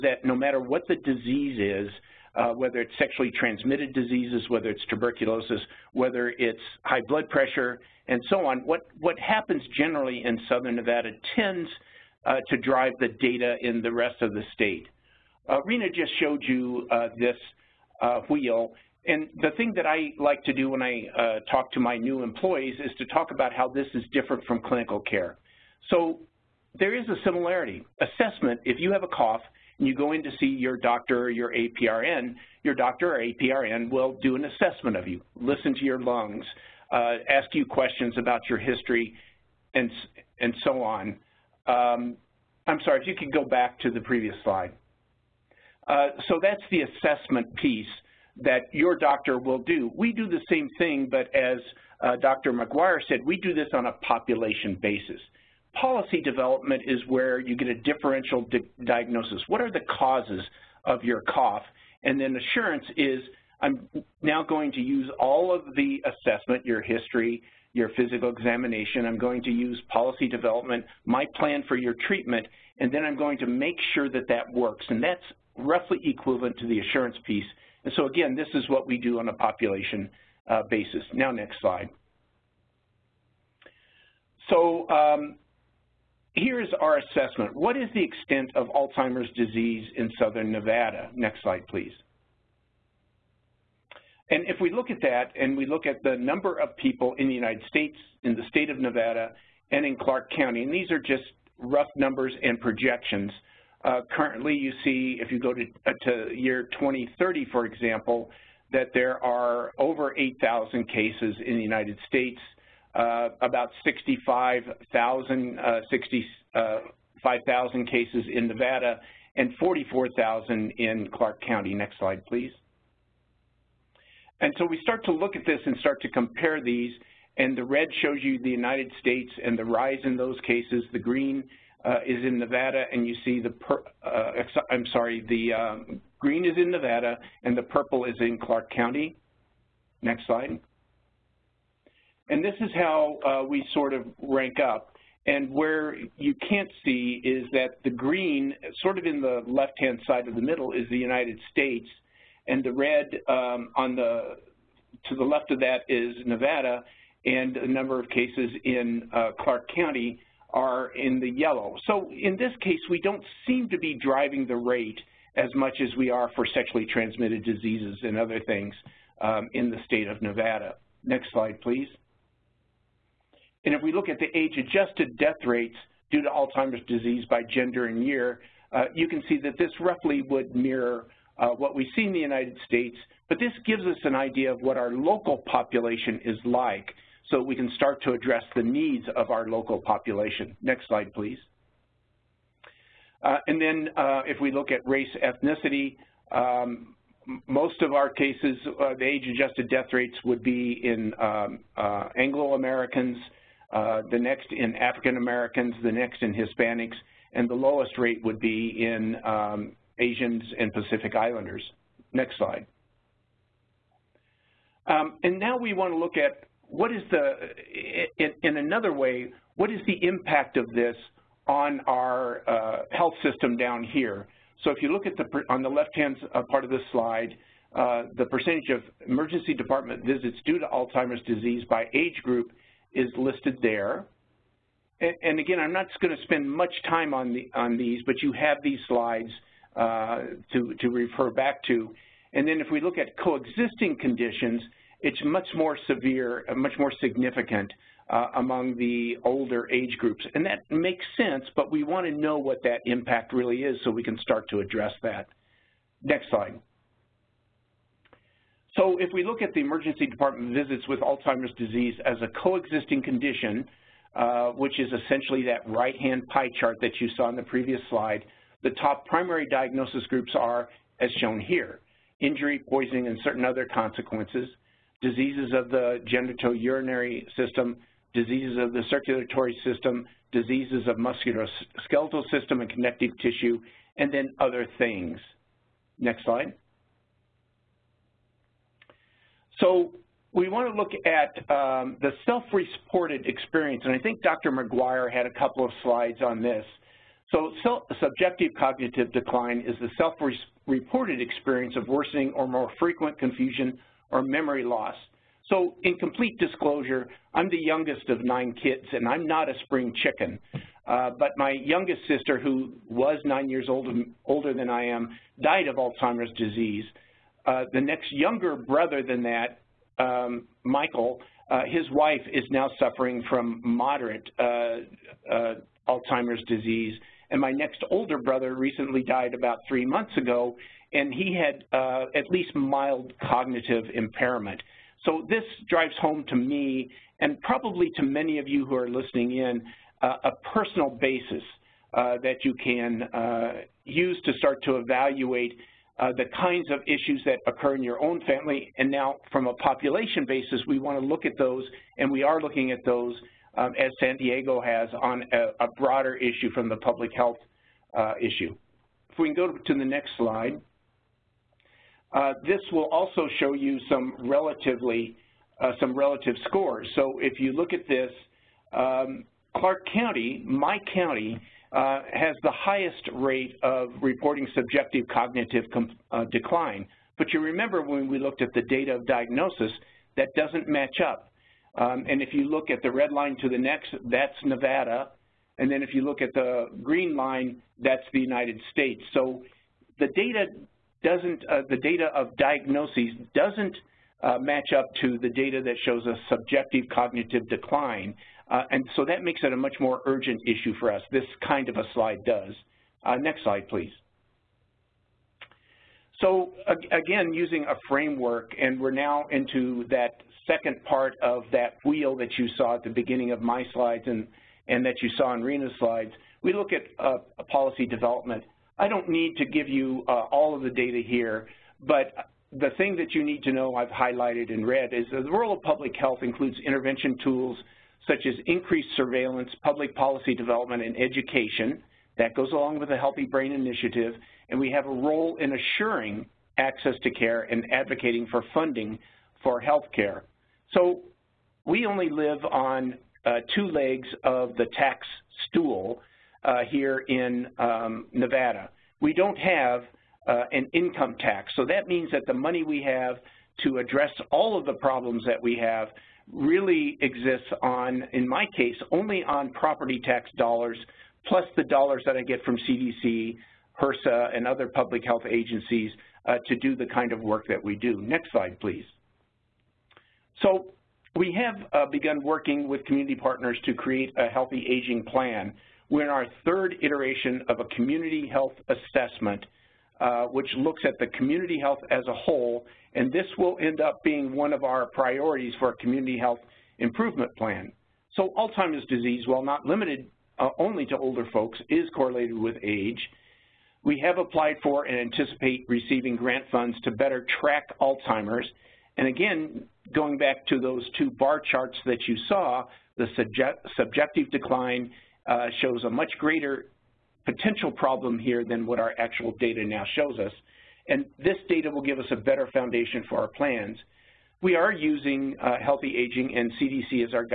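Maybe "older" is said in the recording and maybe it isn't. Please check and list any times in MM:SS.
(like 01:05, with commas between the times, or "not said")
04:09, 05:14, 05:27, 08:10.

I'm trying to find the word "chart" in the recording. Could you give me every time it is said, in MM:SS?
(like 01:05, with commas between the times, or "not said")
04:26, 08:21.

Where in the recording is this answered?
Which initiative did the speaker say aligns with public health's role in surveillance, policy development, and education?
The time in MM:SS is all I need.
07:12.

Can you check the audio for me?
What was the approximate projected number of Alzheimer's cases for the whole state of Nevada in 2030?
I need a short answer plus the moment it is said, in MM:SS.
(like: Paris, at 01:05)
65,000, at 01:53.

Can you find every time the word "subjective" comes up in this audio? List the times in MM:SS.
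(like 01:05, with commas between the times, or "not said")
04:58, 06:14, 06:36, 08:23.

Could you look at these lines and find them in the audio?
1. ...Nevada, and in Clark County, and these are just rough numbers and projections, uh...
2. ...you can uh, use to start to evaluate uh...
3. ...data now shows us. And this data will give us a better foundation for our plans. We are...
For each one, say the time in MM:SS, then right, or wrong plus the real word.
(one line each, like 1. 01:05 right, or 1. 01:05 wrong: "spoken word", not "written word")
1. 01:38 right
2. 05:42 right
3. 08:29 right.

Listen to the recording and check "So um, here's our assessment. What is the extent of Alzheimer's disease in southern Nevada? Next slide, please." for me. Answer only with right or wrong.
right.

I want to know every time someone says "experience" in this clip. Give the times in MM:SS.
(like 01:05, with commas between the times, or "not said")
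04:53, 05:01.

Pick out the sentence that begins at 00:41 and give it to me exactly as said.
Um, I'm sorry, if you could go back to the previous slide.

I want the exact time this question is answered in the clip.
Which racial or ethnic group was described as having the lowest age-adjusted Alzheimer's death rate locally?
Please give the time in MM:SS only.
03:29.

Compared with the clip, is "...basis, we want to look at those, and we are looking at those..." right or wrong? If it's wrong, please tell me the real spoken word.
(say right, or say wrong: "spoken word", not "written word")
right.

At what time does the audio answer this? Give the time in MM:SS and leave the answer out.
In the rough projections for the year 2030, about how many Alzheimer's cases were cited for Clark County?
01:59.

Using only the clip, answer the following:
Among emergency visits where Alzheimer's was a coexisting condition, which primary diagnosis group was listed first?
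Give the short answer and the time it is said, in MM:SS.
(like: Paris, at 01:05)
Injury, at 04:32.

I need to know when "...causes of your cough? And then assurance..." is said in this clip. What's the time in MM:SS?
00:59.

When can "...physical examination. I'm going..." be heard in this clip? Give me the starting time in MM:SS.
01:07.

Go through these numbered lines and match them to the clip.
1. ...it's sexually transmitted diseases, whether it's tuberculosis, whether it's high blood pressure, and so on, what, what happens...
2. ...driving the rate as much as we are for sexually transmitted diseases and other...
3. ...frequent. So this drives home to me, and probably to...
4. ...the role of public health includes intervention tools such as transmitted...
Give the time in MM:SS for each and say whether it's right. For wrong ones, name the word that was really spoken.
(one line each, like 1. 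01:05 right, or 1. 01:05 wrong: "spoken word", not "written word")
1. 00:02 right
2. 02:44 right
3. 05:33 wrong: "impairment", not "frequent"
4. 07:05 wrong: "increased", not "transmitted".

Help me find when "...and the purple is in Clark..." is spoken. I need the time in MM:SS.
02:17.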